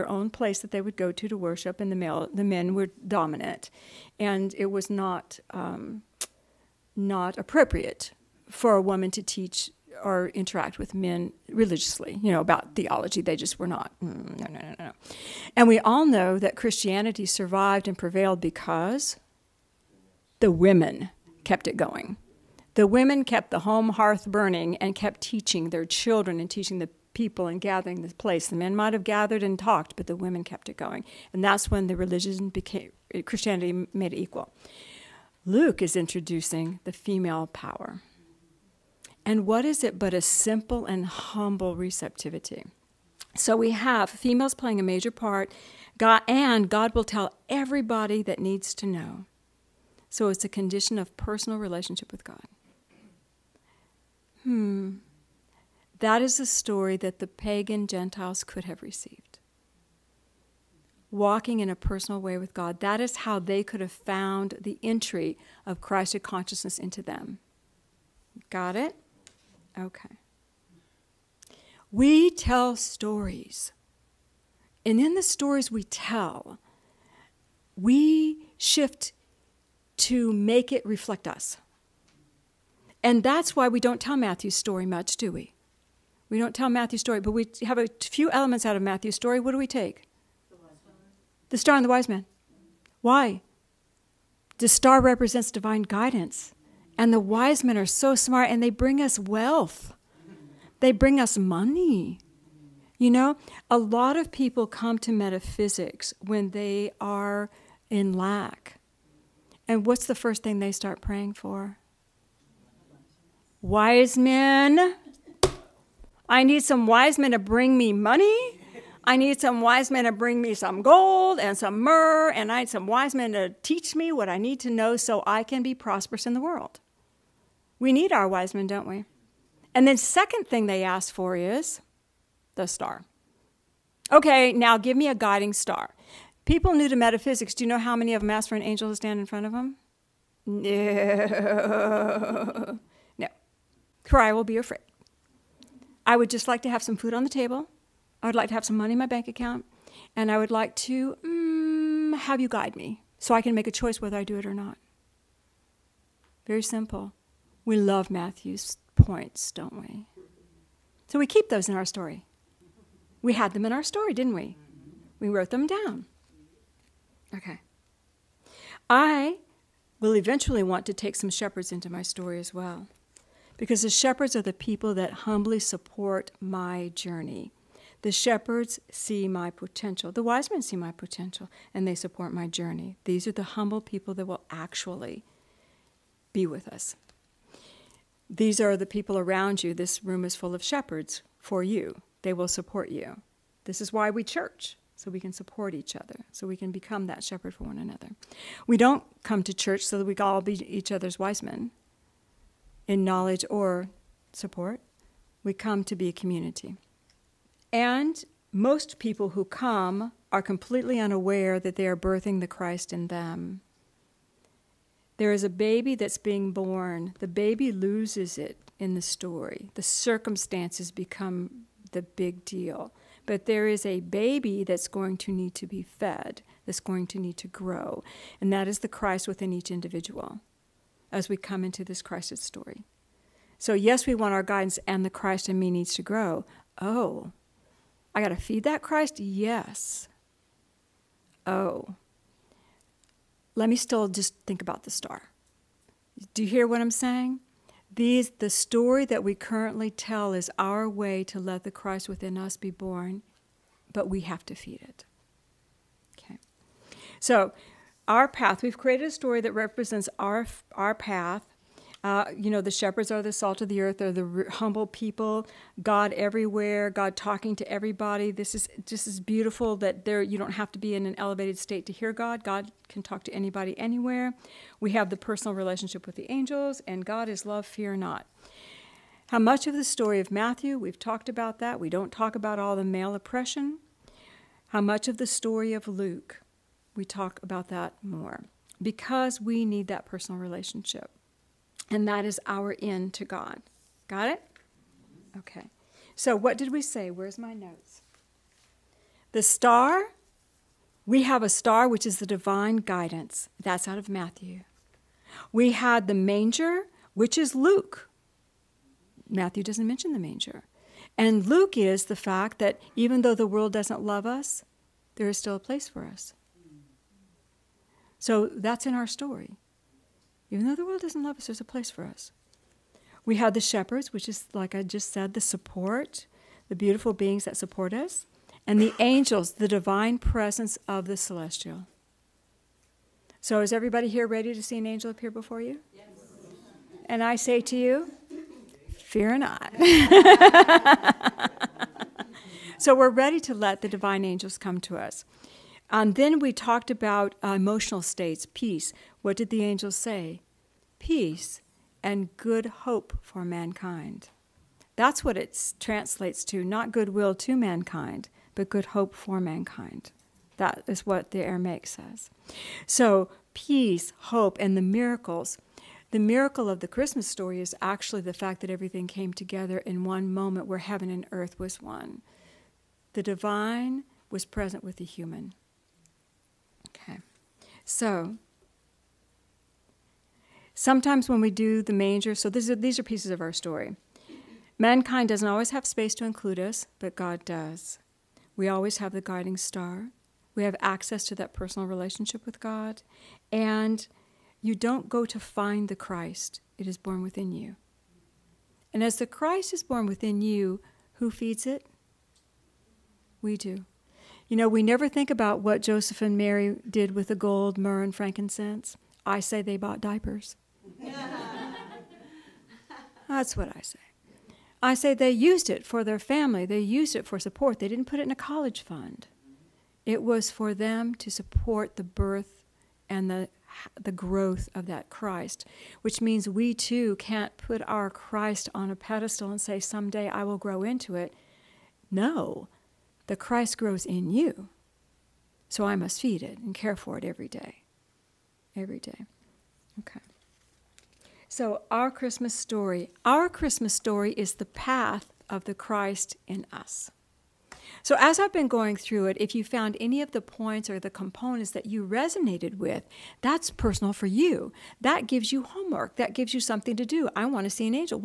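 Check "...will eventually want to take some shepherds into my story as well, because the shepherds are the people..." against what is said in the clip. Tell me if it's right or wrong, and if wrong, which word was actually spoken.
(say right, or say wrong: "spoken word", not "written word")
right.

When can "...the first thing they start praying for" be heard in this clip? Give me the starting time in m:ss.
1:50.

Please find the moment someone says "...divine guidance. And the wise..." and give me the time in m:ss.
1:35.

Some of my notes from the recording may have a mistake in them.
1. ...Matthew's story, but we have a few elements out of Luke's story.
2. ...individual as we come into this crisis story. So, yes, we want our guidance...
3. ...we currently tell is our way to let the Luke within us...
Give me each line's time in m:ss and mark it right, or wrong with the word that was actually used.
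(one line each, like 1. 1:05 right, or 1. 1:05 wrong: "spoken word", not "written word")
1. 1:26 wrong: "Matthew", not "Luke"
2. 3:49 right
3. 4:09 wrong: "Christ", not "Luke".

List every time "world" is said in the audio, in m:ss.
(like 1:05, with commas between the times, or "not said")
2:06, 5:13, 5:20.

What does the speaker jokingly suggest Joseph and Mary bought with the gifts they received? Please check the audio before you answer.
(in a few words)
Diapers.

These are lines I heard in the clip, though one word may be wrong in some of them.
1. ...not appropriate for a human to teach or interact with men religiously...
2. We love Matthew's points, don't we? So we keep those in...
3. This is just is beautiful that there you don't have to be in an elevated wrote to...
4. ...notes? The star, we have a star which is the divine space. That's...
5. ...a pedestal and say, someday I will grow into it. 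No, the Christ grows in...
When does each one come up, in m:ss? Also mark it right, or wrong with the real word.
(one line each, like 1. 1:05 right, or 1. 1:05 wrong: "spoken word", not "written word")
1. 0:06 wrong: "woman", not "human"
2. 2:37 right
3. 4:28 wrong: "state", not "wrote"
4. 4:57 wrong: "guidance", not "space"
5. 7:08 right.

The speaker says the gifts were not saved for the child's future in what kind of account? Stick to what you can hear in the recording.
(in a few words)
A college fund.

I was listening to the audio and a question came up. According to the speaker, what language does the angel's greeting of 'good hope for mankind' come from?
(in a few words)
Aramaic.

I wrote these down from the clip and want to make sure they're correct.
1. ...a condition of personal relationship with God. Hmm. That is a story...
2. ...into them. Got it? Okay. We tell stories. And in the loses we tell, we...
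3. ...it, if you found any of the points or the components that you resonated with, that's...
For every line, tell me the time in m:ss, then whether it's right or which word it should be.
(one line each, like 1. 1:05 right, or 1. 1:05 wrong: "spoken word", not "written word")
1. 0:50 right
2. 1:06 wrong: "stories", not "loses"
3. 7:29 right.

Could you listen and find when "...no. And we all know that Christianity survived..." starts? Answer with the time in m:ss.
0:14.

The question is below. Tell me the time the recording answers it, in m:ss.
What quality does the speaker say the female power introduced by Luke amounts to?
0:40.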